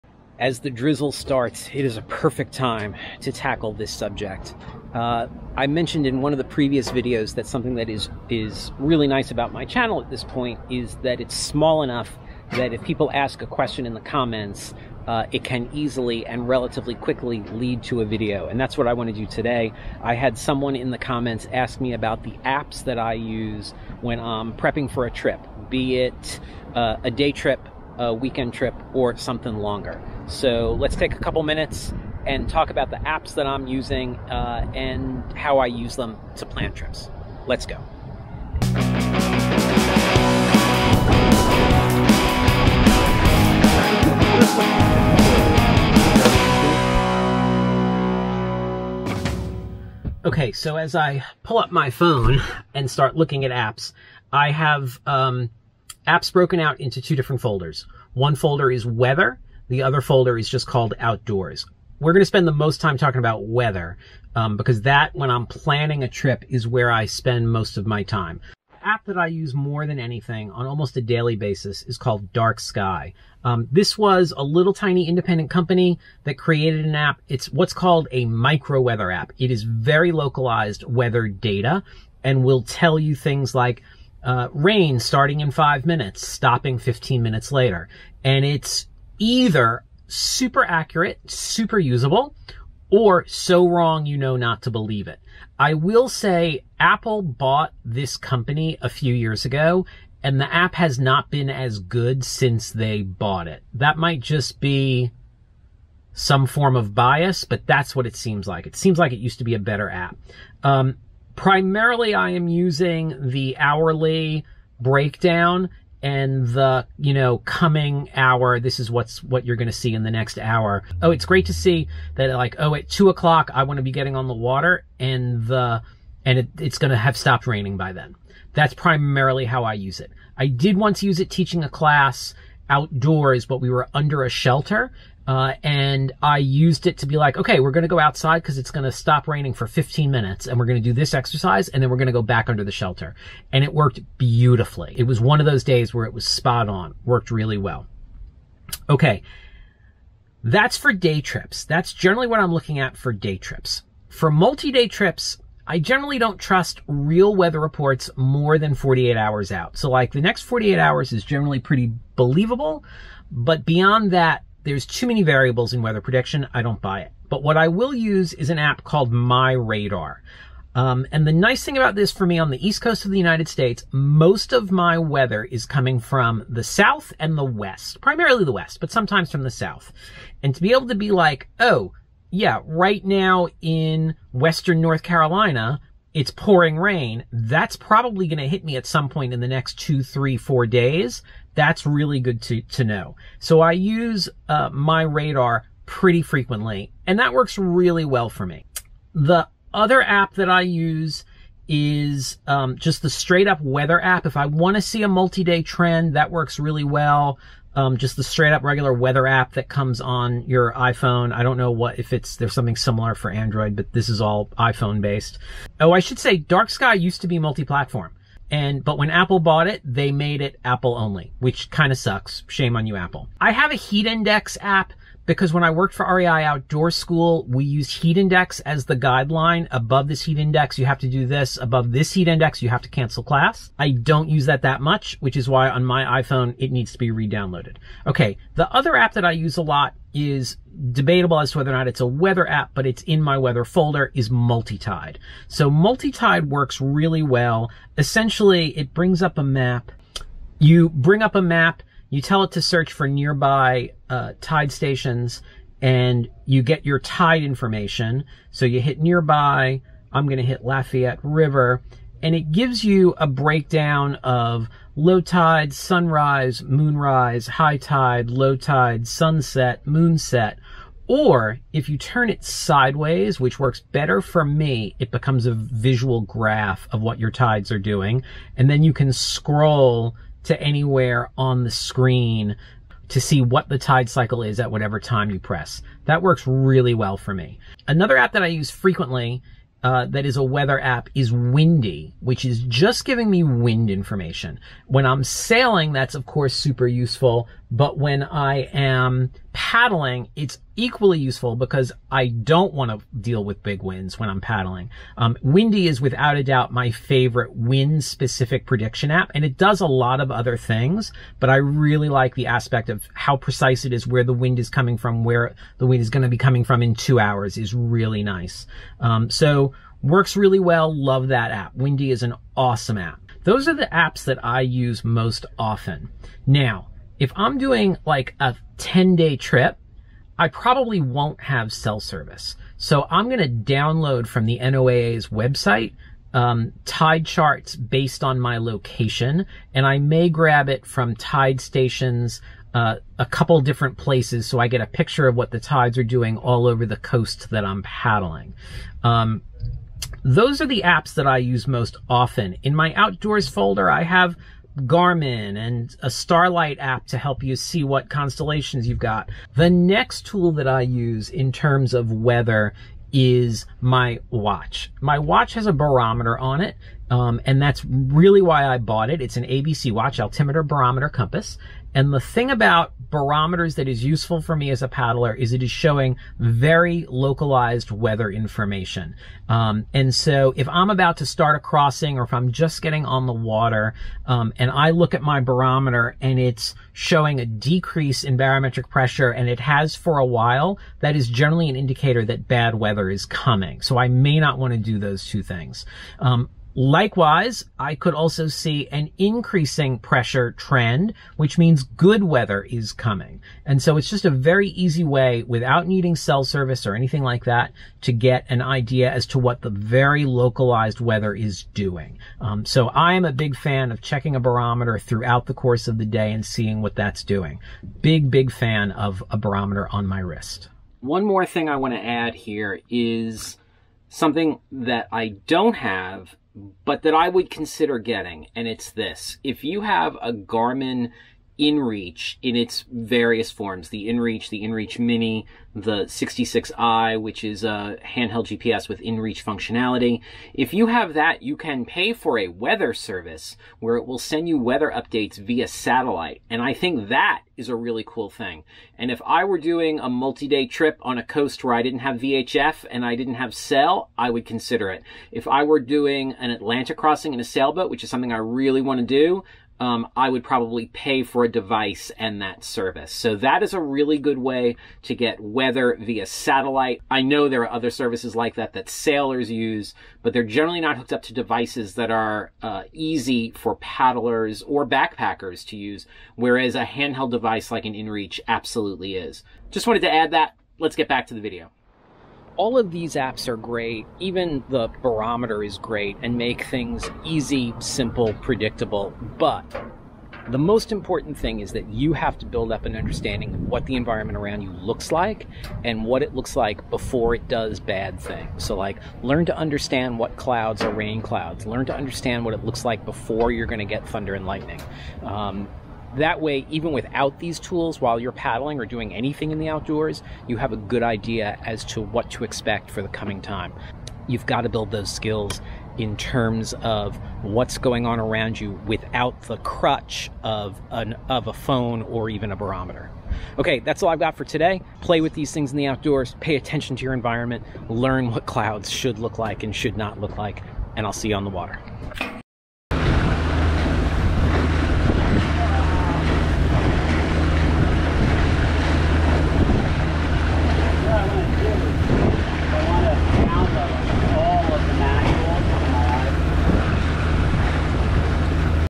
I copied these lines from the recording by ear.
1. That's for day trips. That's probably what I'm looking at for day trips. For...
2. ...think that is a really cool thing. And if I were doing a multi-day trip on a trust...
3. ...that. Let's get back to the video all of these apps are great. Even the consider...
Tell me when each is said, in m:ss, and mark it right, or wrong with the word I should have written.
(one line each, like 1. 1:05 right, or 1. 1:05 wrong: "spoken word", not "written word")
1. 2:30 wrong: "generally", not "probably"
2. 7:26 wrong: "coast", not "trust"
3. 8:00 wrong: "barometer", not "consider".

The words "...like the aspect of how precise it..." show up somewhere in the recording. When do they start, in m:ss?
5:12.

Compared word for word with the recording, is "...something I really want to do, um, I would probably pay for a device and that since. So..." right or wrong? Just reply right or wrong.
wrong.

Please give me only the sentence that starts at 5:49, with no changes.
Um, those are the apps that I use most often.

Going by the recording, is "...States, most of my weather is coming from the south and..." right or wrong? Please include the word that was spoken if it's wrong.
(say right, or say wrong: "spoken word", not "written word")
right.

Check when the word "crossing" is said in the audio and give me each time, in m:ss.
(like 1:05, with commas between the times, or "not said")
6:21, 7:36.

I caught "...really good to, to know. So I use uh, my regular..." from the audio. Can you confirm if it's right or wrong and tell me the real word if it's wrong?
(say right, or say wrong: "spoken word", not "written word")
wrong: "radar", not "regular".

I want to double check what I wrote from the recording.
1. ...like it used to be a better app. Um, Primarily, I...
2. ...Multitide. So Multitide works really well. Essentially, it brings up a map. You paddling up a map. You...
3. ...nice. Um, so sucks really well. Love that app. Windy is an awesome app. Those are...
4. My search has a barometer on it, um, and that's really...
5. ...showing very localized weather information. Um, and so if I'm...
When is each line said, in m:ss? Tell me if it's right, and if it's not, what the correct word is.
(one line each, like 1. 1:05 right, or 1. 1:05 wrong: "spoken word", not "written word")
1. 1:48 right
2. 4:04 wrong: "bring", not "paddling"
3. 5:18 wrong: "works", not "sucks"
4. 6:05 wrong: "watch", not "search"
5. 6:15 right.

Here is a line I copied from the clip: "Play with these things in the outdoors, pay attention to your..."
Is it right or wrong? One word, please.
right.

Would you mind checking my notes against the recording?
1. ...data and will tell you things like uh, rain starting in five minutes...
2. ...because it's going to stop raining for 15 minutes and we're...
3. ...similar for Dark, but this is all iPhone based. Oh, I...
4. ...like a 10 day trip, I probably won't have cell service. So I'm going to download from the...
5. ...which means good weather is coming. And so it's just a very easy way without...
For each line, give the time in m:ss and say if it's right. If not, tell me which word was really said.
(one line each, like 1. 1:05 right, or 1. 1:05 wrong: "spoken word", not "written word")
1. 1:21 right
2. 2:18 right
3. 3:32 wrong: "Android", not "Dark"
4. 5:28 right
5. 6:41 right.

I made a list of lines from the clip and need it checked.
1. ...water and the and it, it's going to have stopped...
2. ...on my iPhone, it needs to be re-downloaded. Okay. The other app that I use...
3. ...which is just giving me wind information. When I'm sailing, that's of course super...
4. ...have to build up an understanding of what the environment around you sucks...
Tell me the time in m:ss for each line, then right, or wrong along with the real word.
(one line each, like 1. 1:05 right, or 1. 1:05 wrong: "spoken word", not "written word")
1. 2:04 right
2. 3:55 right
3. 4:52 right
4. 8:12 wrong: "looks", not "sucks".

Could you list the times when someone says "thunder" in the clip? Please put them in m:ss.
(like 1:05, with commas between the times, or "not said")
8:24.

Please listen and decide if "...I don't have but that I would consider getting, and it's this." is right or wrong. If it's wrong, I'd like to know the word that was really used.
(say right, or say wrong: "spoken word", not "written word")
right.